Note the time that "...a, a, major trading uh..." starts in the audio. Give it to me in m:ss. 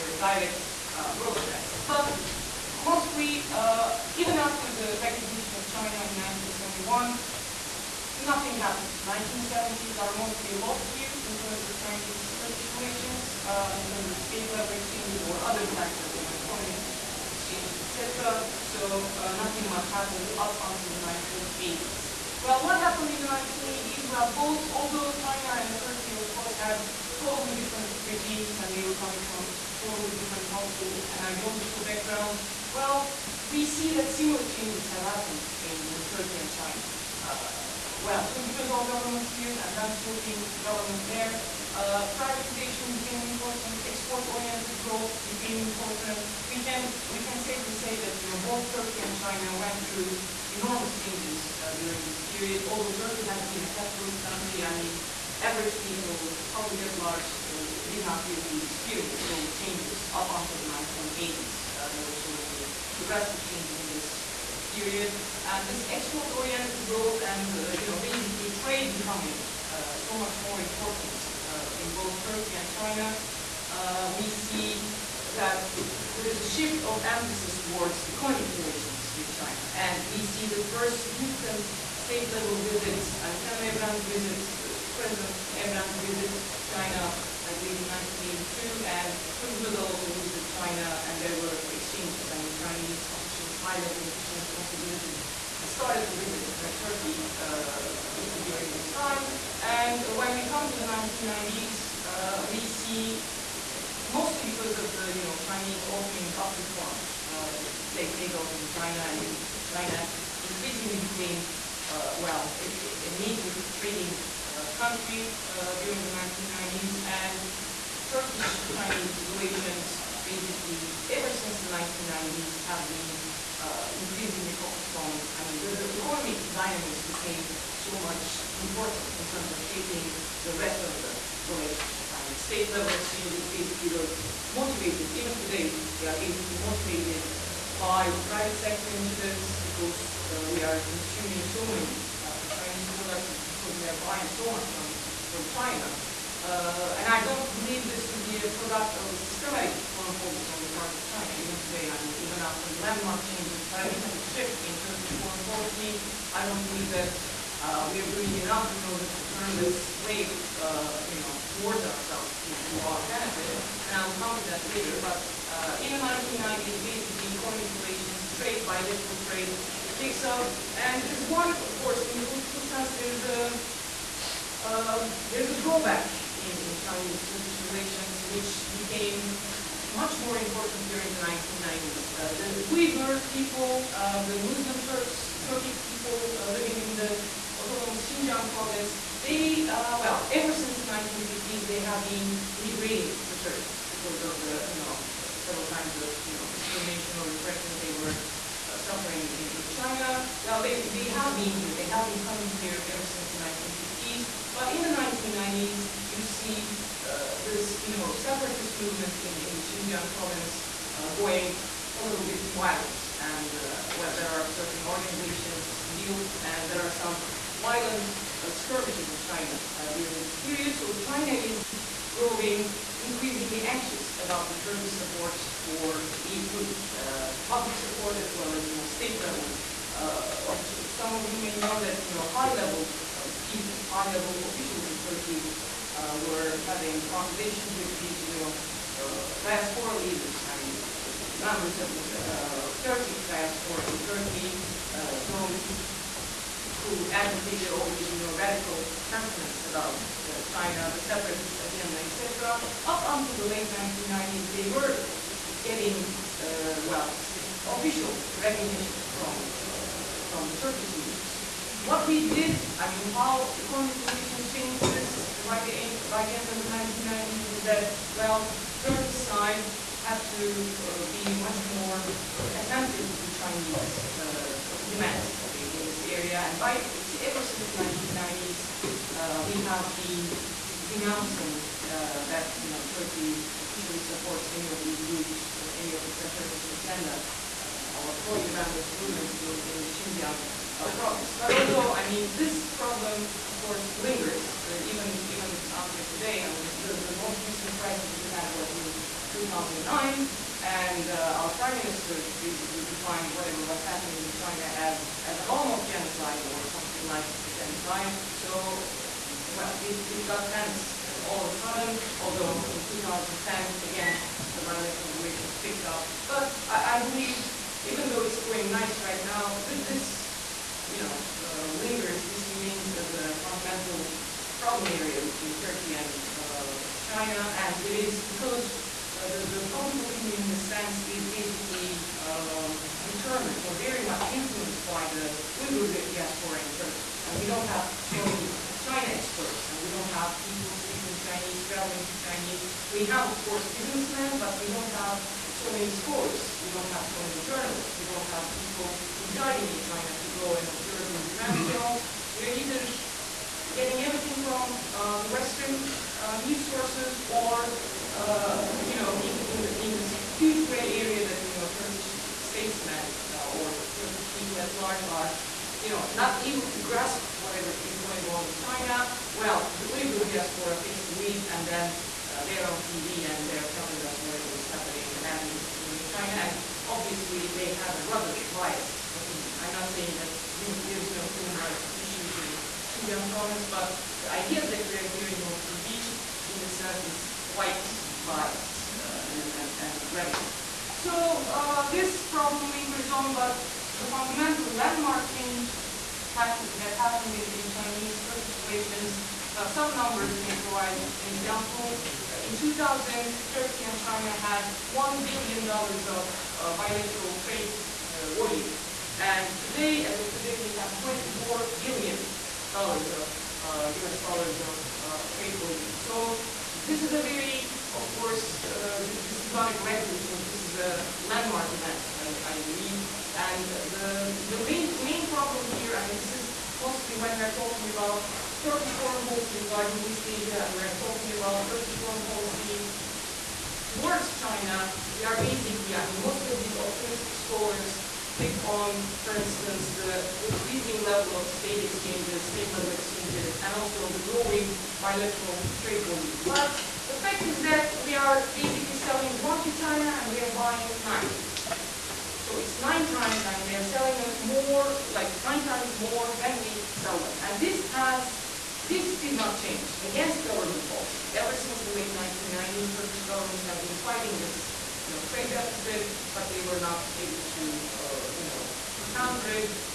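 1:52.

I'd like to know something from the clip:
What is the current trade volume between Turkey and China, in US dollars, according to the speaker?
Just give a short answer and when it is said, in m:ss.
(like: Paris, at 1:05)
$24 billion, at 6:51.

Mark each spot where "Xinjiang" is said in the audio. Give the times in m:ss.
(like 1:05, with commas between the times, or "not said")
3:08, 3:29, 4:49, 6:23.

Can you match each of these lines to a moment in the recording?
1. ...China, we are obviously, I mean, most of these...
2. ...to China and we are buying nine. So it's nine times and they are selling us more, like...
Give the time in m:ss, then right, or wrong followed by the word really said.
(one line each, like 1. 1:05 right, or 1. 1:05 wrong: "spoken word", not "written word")
1. 7:14 wrong: "basically", not "obviously"
2. 7:29 right.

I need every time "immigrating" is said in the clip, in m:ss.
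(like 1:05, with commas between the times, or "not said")
3:12.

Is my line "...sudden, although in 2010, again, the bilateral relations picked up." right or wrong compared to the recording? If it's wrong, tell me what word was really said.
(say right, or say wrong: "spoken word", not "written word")
right.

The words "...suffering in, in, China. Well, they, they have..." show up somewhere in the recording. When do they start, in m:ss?
3:18.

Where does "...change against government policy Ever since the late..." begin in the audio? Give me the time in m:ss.
7:39.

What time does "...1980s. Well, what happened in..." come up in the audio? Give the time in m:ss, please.
0:21.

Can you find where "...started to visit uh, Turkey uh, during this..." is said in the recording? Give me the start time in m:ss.
1:35.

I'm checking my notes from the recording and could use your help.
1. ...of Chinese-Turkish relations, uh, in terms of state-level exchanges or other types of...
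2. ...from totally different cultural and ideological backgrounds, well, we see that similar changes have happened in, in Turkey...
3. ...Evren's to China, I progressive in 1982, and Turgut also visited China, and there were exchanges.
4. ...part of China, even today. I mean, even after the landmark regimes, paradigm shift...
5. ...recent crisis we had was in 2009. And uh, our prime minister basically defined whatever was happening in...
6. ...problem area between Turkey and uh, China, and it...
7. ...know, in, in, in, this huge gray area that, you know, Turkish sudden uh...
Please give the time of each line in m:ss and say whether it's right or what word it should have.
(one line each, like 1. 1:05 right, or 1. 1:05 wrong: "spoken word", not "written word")
1. 0:11 right
2. 0:29 right
3. 1:25 wrong: "believe", not "progressive"
4. 2:30 wrong: "changes", not "regimes"
5. 4:57 right
6. 5:24 right
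7. 5:58 wrong: "statesmen", not "sudden".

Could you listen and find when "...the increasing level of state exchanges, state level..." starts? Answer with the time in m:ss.
7:19.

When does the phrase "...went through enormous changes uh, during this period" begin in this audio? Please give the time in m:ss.
0:49.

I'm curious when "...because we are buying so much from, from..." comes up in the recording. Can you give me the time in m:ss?
2:23.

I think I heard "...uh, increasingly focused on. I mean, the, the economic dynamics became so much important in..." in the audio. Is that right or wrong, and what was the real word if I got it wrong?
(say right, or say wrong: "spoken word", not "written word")
right.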